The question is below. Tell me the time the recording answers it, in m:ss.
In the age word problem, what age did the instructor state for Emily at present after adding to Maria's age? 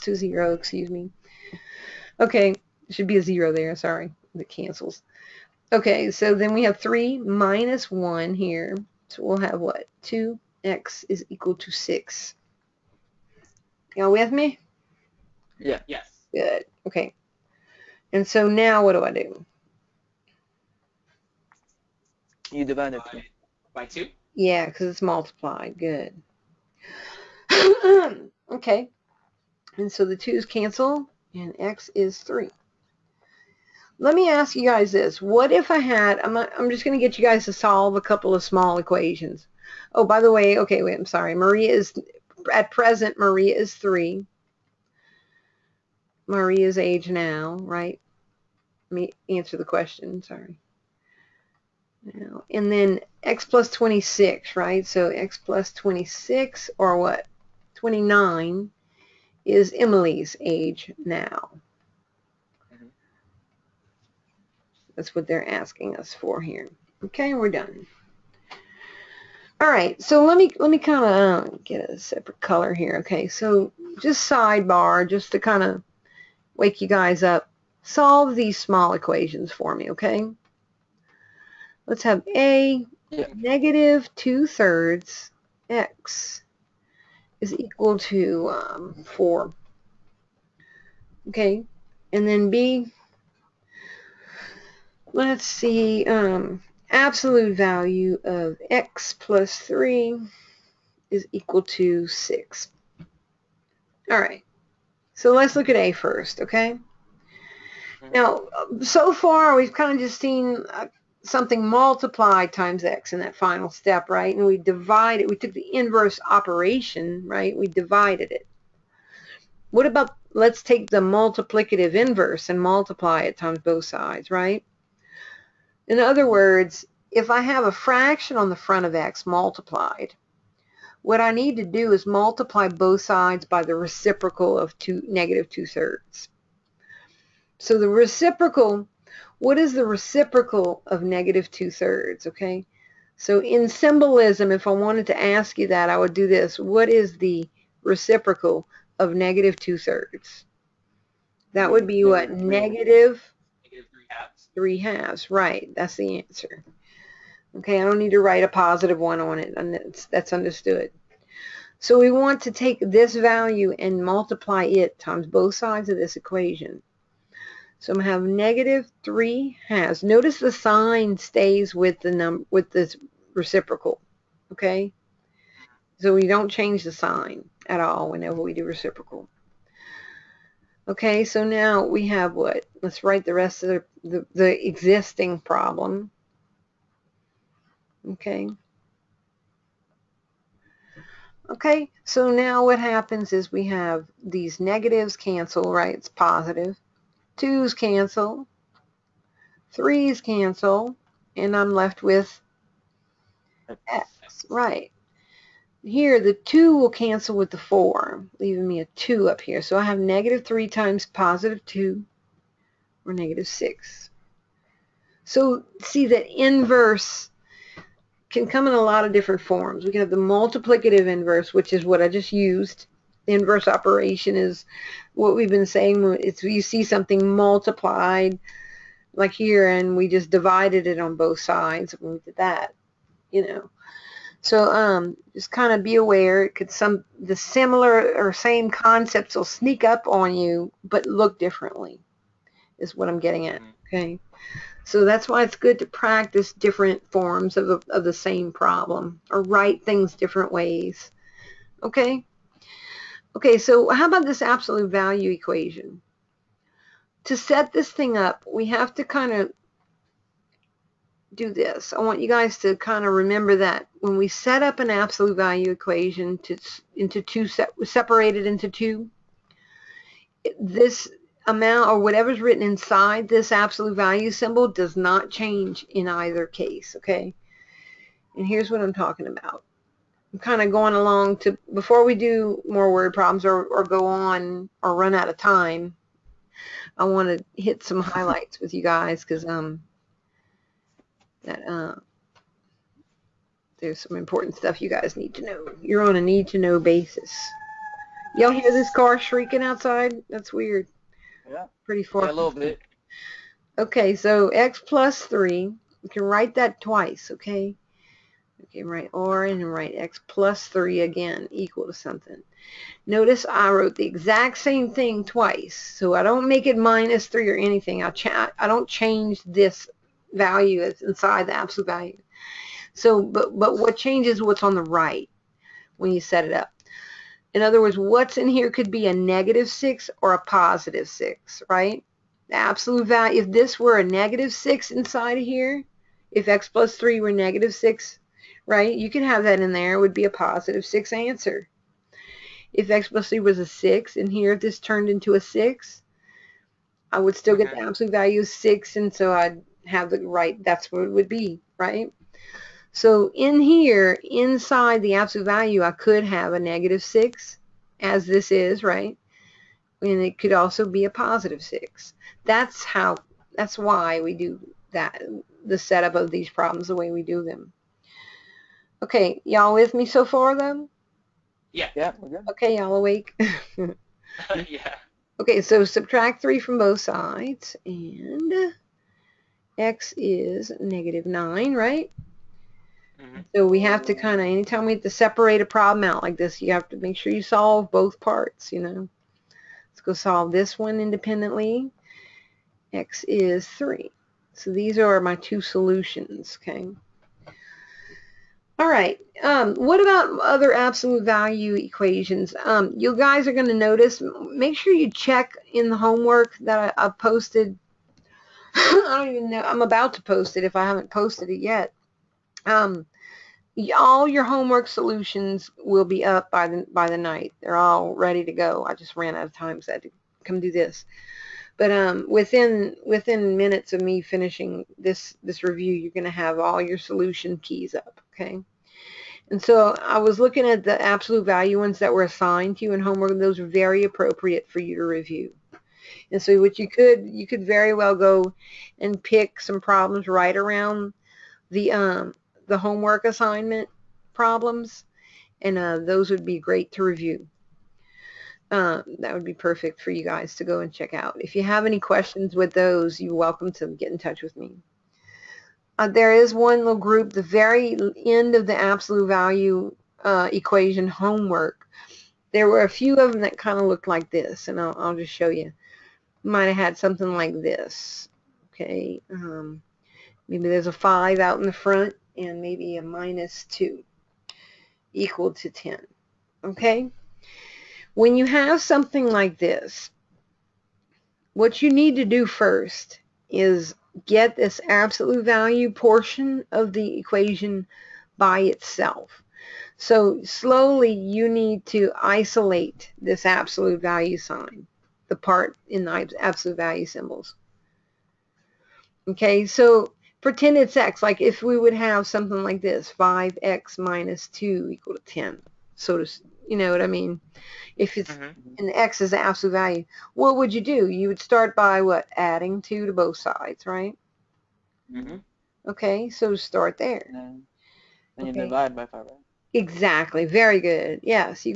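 0:57.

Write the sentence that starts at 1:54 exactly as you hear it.
And we divided, we took the inverse operation, right?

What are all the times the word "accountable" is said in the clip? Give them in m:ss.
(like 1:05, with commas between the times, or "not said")
not said.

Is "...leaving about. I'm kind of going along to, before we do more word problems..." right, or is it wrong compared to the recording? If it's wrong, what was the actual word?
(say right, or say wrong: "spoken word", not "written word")
wrong: "talking", not "leaving".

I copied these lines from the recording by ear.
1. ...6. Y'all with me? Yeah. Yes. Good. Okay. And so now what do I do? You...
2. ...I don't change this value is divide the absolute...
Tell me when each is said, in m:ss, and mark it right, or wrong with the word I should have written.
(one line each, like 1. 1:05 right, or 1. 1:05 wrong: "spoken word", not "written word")
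1. 0:11 right
2. 5:18 wrong: "inside", not "divide".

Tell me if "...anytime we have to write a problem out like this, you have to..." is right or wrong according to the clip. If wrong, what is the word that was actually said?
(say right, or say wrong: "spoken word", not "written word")
wrong: "separate", not "write".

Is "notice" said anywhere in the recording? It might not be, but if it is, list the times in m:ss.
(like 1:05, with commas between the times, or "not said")
2:50, 5:13, 6:43.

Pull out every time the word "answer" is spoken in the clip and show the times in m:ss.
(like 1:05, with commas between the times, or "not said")
0:49, 2:36, 5:41.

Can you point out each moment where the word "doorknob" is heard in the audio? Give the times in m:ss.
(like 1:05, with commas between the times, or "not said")
not said.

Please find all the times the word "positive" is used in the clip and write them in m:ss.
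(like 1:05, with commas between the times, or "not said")
2:38, 3:16, 3:31, 5:30, 5:40, 6:01.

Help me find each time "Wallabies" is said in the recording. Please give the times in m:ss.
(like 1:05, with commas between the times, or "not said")
not said.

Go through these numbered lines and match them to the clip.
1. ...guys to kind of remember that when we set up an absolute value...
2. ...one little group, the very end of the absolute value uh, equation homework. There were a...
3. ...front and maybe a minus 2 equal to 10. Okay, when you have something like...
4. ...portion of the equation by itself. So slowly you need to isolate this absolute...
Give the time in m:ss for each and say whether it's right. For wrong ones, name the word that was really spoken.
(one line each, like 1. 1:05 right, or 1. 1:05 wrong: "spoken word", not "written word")
1. 4:22 right
2. 7:36 right
3. 7:51 right
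4. 8:05 right.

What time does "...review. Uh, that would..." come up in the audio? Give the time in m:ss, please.
7:27.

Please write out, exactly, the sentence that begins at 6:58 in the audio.
I just ran out of time, so I had to come do this.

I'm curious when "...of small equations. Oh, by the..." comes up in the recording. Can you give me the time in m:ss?
0:38.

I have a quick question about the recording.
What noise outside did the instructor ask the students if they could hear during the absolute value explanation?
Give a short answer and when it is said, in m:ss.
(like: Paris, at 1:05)
car shrieking, at 4:58.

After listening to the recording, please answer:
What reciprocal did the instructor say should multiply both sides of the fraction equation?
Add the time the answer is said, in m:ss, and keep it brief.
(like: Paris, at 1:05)
Negative three halves, at 2:32.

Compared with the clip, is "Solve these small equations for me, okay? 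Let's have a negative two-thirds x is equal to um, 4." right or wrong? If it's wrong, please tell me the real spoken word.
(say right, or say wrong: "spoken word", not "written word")
right.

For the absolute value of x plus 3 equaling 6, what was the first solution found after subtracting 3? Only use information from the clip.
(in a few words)
-9.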